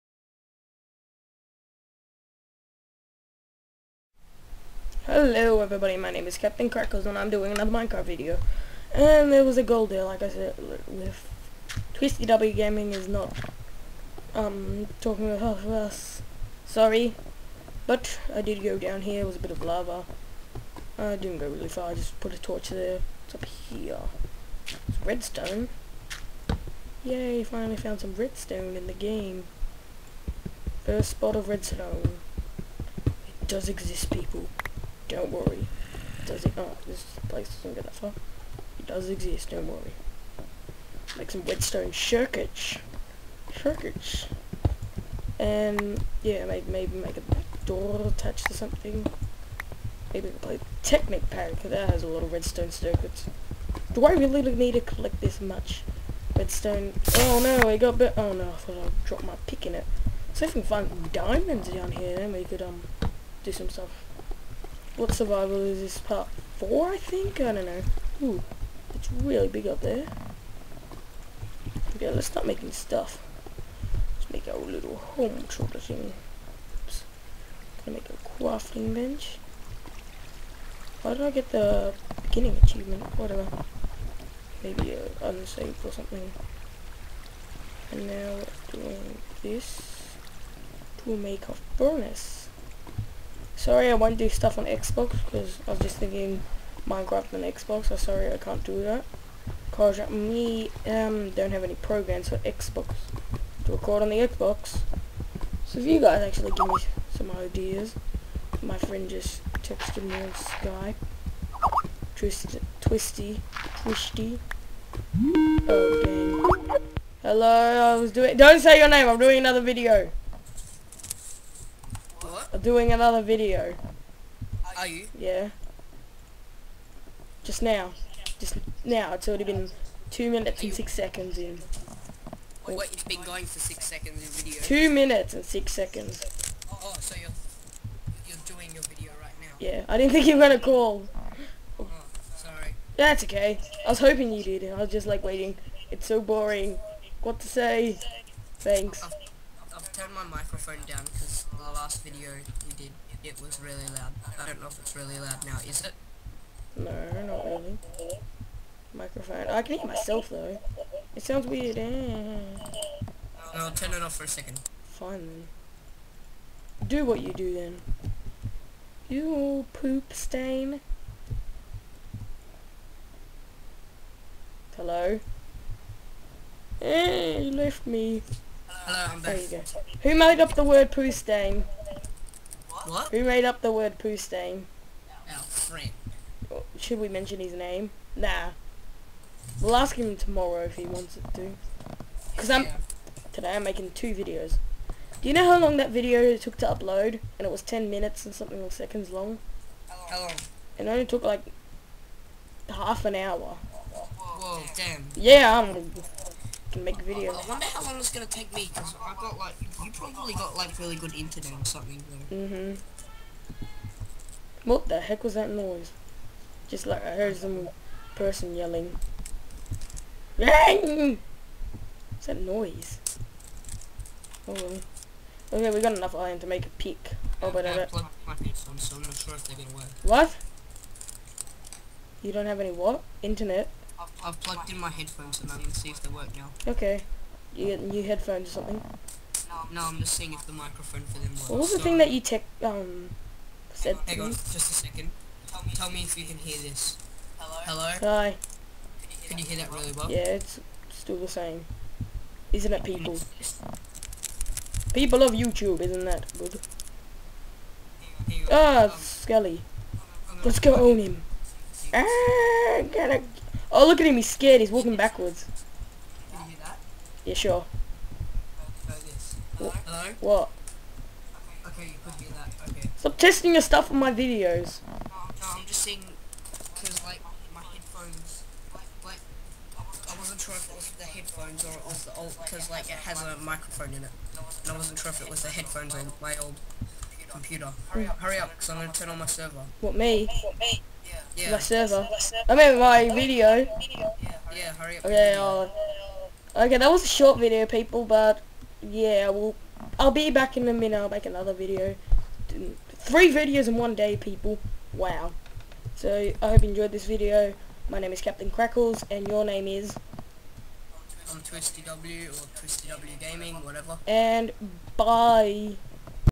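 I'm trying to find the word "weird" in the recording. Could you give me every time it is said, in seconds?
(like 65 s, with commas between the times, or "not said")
161 s.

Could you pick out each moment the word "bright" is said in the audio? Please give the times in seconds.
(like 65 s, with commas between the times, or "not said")
not said.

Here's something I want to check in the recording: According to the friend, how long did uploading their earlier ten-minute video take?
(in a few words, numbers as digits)
Half an hour.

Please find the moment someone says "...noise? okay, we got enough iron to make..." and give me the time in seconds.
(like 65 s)
222 s.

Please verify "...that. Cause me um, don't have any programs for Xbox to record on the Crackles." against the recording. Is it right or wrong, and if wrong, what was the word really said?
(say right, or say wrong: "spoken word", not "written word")
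wrong: "Xbox", not "Crackles".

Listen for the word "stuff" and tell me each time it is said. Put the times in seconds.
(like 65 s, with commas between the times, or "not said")
63 s, 72 s, 94 s, 273 s.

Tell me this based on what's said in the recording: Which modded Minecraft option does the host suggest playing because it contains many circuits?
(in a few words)
Technic Pack.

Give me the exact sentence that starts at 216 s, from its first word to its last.
Just like I heard some person yelling.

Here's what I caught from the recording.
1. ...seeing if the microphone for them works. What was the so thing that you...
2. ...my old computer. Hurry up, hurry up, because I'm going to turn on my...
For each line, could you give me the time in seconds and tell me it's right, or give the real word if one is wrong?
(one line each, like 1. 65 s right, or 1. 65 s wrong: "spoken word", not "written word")
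1. 240 s right
2. 286 s right.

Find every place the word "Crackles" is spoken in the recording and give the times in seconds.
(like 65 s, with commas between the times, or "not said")
6 s, 308 s.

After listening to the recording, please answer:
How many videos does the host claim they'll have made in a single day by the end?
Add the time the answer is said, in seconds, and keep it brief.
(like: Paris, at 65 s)
3, at 302 s.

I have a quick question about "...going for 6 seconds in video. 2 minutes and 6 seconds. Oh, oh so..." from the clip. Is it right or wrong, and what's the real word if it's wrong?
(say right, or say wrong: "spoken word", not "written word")
right.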